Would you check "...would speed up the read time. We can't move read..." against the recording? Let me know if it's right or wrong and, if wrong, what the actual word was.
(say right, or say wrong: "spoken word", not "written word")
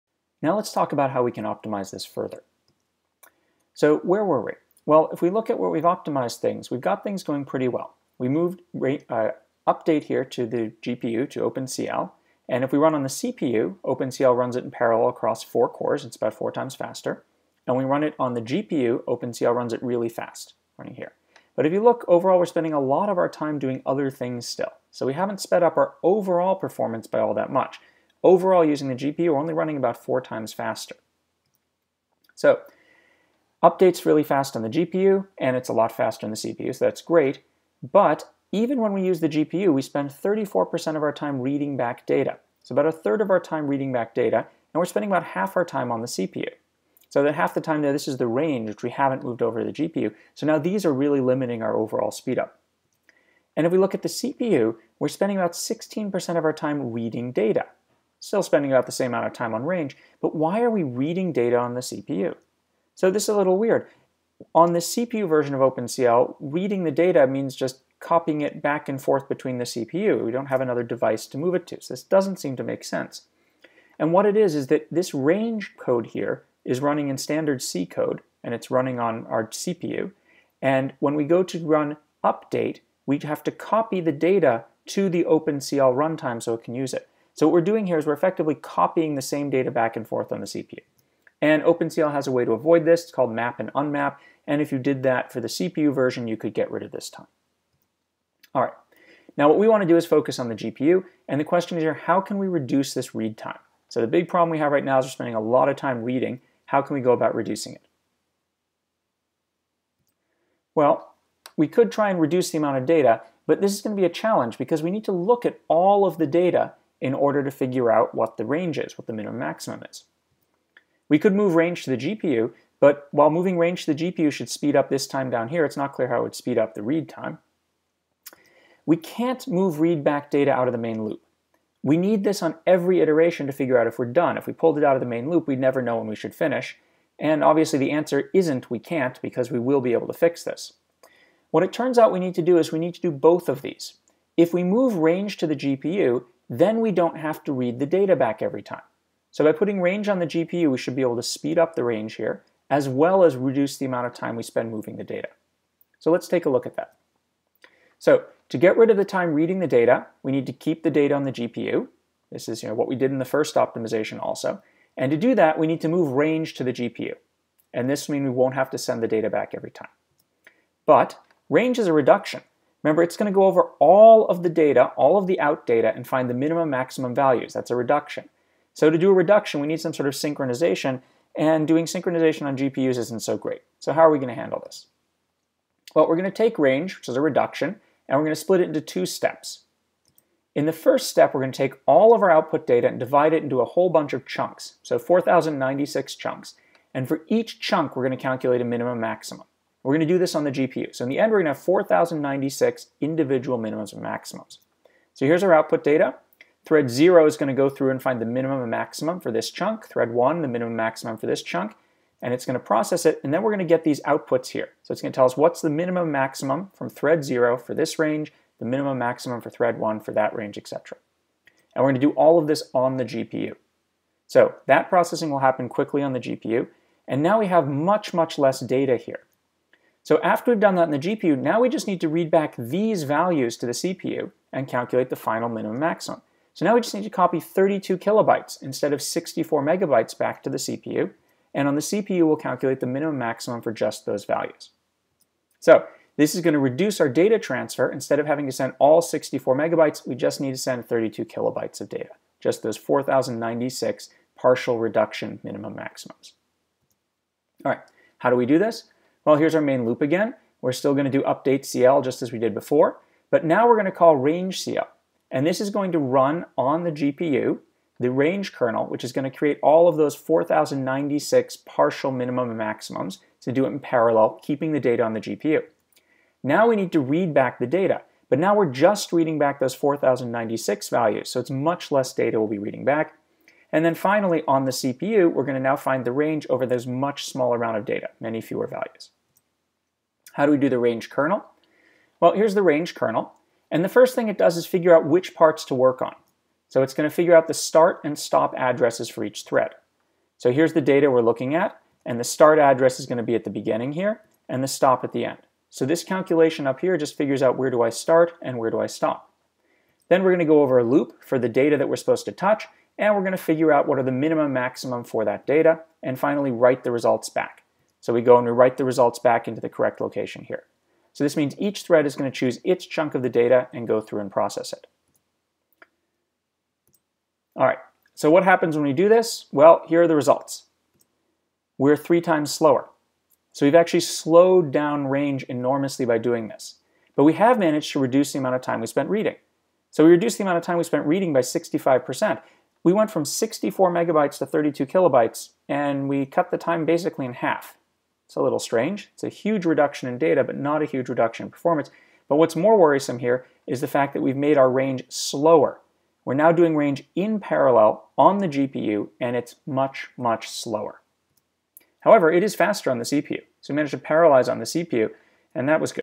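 right.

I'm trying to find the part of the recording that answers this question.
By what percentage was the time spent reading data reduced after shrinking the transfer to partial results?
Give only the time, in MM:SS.
05:41.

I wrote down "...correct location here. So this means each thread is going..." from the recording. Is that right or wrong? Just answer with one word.
right.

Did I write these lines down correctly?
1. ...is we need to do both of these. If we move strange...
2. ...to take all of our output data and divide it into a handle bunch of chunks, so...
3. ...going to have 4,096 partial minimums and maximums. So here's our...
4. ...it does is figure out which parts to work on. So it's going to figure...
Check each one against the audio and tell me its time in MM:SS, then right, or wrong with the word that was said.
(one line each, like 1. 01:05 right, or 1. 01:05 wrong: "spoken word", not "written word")
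1. 02:22 wrong: "range", not "strange"
2. 03:11 wrong: "whole", not "handle"
3. 03:21 wrong: "individual", not "partial"
4. 04:54 right.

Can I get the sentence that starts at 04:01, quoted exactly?
And on the CPU, we'll calculate the minimum maximum for just those values.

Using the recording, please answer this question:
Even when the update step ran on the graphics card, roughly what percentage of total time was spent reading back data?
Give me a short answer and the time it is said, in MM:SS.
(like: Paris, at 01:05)
34%, at 00:40.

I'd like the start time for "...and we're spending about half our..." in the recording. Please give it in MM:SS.
00:44.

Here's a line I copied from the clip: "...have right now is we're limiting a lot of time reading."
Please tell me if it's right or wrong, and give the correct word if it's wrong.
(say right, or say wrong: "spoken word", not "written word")
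wrong: "spending", not "limiting".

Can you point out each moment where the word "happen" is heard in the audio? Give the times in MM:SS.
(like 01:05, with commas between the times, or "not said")
03:45, 05:28.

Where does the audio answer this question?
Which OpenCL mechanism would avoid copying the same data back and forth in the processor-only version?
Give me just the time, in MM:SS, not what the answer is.
01:33.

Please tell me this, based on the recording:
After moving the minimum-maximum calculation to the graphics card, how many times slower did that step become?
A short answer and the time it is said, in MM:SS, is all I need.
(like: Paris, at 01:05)
three times, at 05:31.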